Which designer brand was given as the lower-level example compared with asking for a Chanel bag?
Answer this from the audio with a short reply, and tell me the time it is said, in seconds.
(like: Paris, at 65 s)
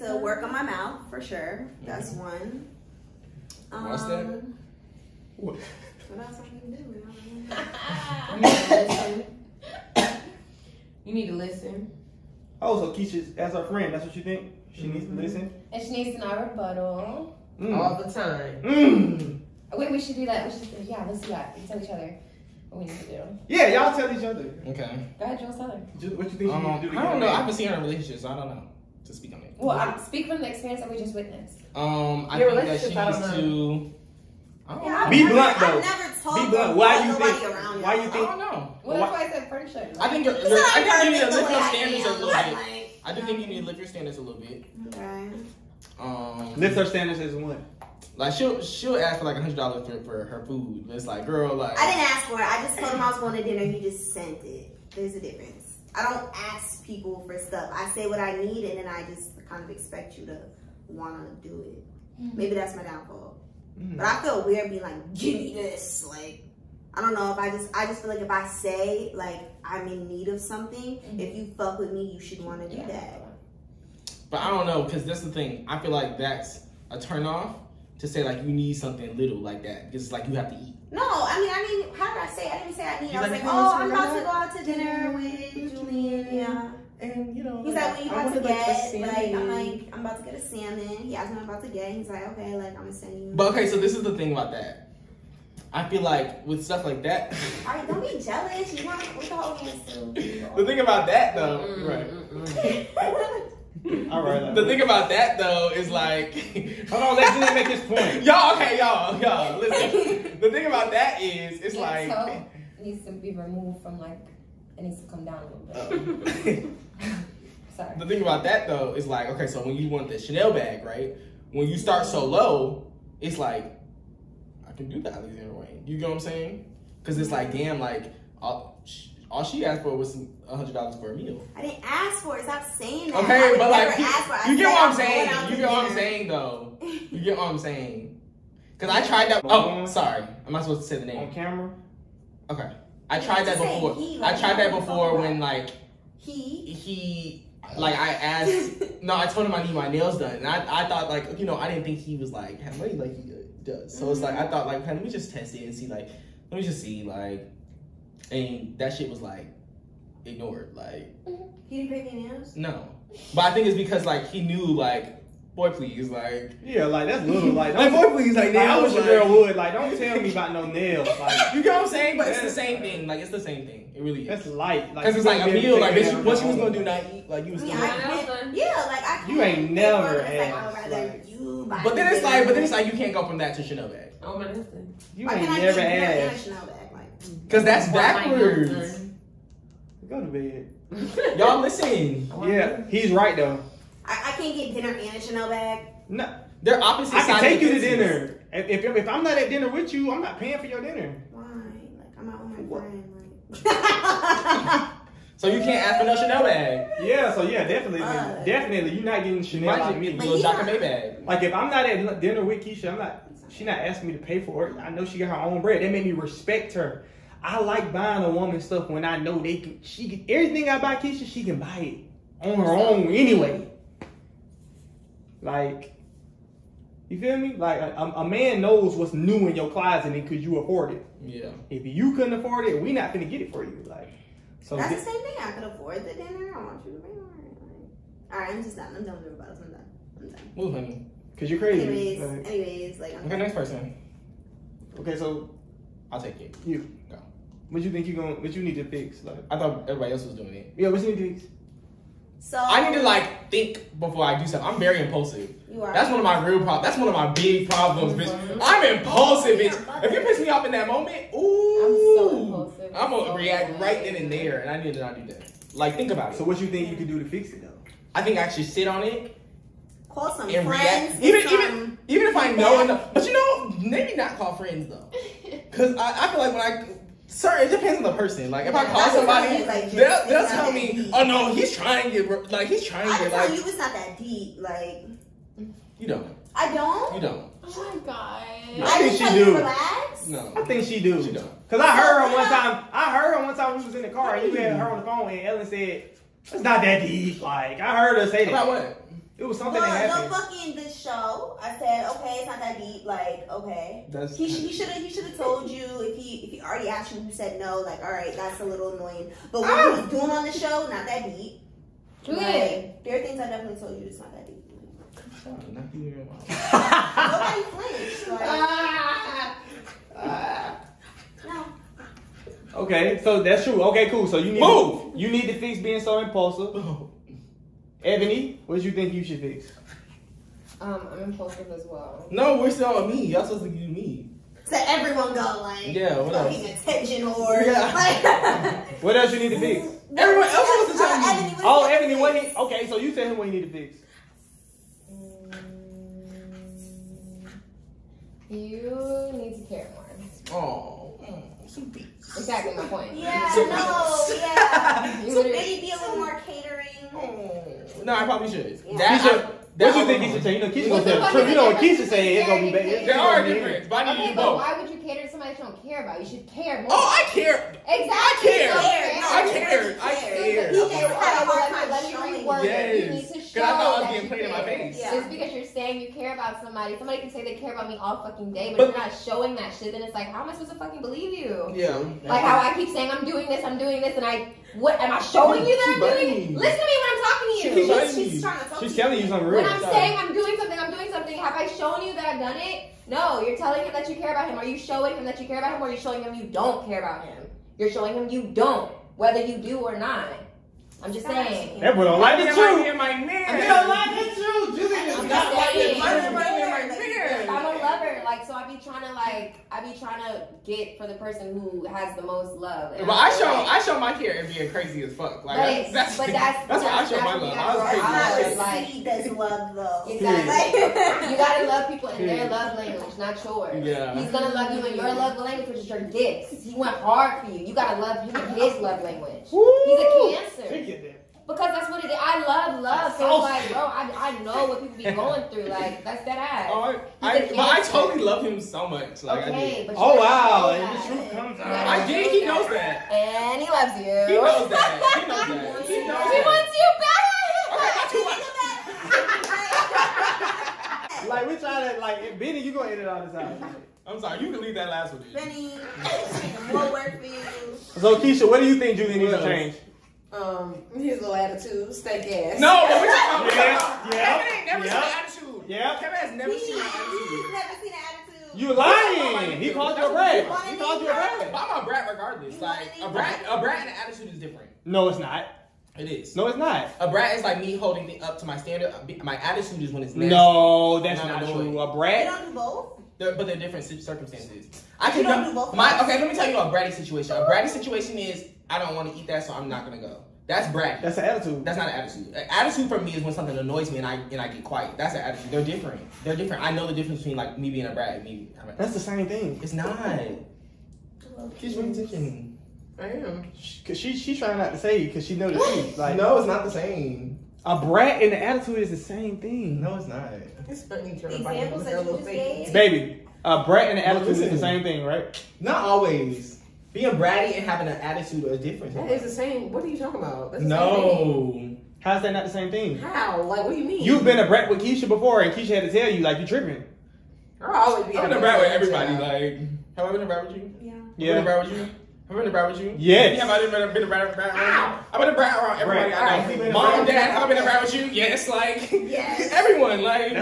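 Alexander Wang, at 125 s.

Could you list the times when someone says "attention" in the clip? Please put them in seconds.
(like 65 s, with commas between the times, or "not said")
336 s, 501 s.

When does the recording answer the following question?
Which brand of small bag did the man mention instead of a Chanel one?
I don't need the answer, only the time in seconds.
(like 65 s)
210 s.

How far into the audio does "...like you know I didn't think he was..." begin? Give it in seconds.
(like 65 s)
151 s.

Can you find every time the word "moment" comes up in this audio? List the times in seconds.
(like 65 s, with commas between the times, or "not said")
260 s.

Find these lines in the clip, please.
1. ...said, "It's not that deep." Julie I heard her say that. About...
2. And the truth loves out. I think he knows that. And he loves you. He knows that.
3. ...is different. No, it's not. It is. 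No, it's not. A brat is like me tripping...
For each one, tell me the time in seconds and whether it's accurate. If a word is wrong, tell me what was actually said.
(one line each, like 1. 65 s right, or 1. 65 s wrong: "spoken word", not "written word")
1. 295 s wrong: "Like", not "Julie"
2. 440 s wrong: "comes", not "loves"
3. 474 s wrong: "holding", not "tripping".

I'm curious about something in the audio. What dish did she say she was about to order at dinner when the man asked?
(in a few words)
salmon.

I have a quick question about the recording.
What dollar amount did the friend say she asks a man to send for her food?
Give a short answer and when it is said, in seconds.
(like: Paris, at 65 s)
100 dollars, at 49 s.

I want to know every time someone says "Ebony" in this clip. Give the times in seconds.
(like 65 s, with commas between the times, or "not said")
328 s, 341 s.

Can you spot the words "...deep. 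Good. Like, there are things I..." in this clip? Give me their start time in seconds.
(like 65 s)
311 s.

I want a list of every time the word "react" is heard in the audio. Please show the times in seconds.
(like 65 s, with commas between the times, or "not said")
263 s, 271 s.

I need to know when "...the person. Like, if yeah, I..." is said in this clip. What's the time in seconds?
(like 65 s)
278 s.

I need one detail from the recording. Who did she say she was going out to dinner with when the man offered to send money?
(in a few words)
Julian.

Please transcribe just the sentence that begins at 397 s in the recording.
You're showing him you don't, whether you do or not.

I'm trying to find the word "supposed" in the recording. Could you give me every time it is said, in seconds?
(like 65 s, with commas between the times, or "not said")
140 s, 333 s, 380 s.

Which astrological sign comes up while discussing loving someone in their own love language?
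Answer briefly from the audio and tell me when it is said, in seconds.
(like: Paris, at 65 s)
Cancer, at 430 s.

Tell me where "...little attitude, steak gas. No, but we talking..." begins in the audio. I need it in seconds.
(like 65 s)
461 s.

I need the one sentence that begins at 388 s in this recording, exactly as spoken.
she's, she's, she's trying to tell she's telling you something real.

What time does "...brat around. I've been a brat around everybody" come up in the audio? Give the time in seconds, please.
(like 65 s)
534 s.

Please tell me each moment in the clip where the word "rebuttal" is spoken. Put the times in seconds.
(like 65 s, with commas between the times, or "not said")
16 s, 239 s.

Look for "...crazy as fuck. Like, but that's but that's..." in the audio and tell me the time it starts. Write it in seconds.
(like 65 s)
414 s.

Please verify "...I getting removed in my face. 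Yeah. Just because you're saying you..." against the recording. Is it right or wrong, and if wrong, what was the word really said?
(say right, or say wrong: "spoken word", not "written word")
wrong: "played", not "removed".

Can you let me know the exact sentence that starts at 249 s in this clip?
Like I thought everybody else was doing it.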